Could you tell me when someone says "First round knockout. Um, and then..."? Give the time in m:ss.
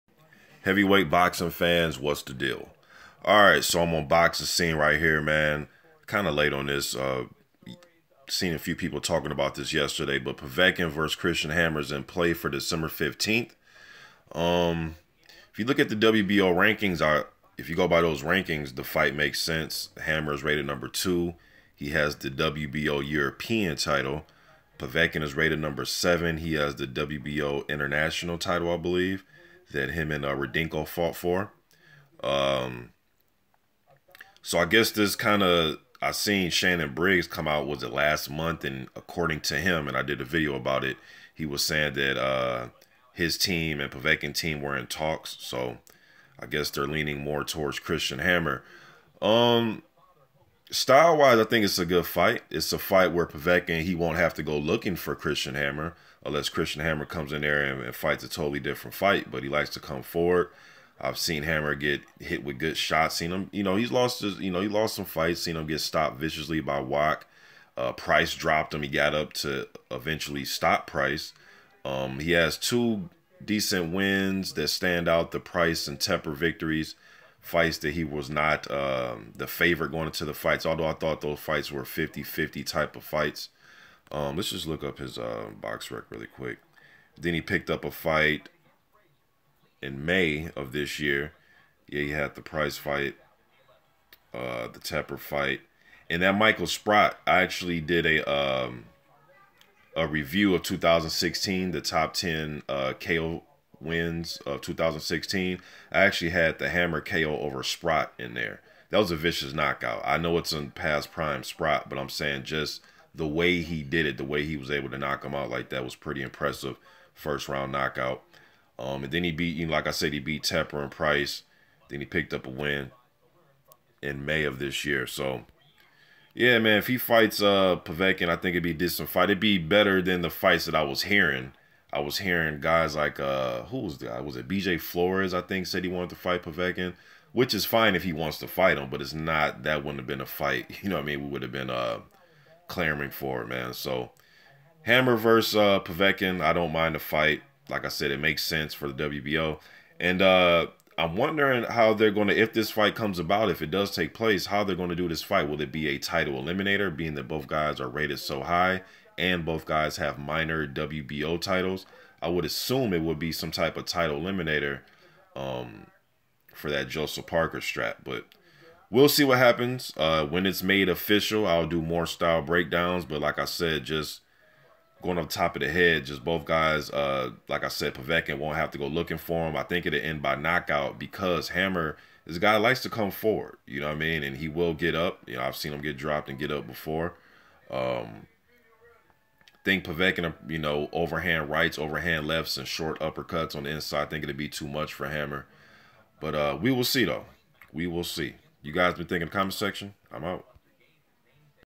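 1:57.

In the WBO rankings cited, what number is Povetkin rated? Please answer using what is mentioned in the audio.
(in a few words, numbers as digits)
7.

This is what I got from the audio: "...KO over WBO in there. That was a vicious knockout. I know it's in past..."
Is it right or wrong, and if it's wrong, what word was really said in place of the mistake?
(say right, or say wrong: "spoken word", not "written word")
wrong: "Sprott", not "WBO".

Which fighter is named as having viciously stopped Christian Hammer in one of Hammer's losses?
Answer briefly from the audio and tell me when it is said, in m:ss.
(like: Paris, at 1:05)
Wok, at 1:06.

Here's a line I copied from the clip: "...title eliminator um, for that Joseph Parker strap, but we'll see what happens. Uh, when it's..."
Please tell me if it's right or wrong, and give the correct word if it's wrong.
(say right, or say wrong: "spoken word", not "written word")
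right.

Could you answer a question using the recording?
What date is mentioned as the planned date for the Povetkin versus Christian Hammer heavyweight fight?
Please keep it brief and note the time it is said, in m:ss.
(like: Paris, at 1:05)
December 15th, at 0:12.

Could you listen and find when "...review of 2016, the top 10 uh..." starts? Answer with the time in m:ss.
1:40.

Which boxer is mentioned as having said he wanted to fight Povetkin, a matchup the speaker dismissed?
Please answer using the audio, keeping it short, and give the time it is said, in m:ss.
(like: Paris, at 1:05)
BJ Flores, at 2:14.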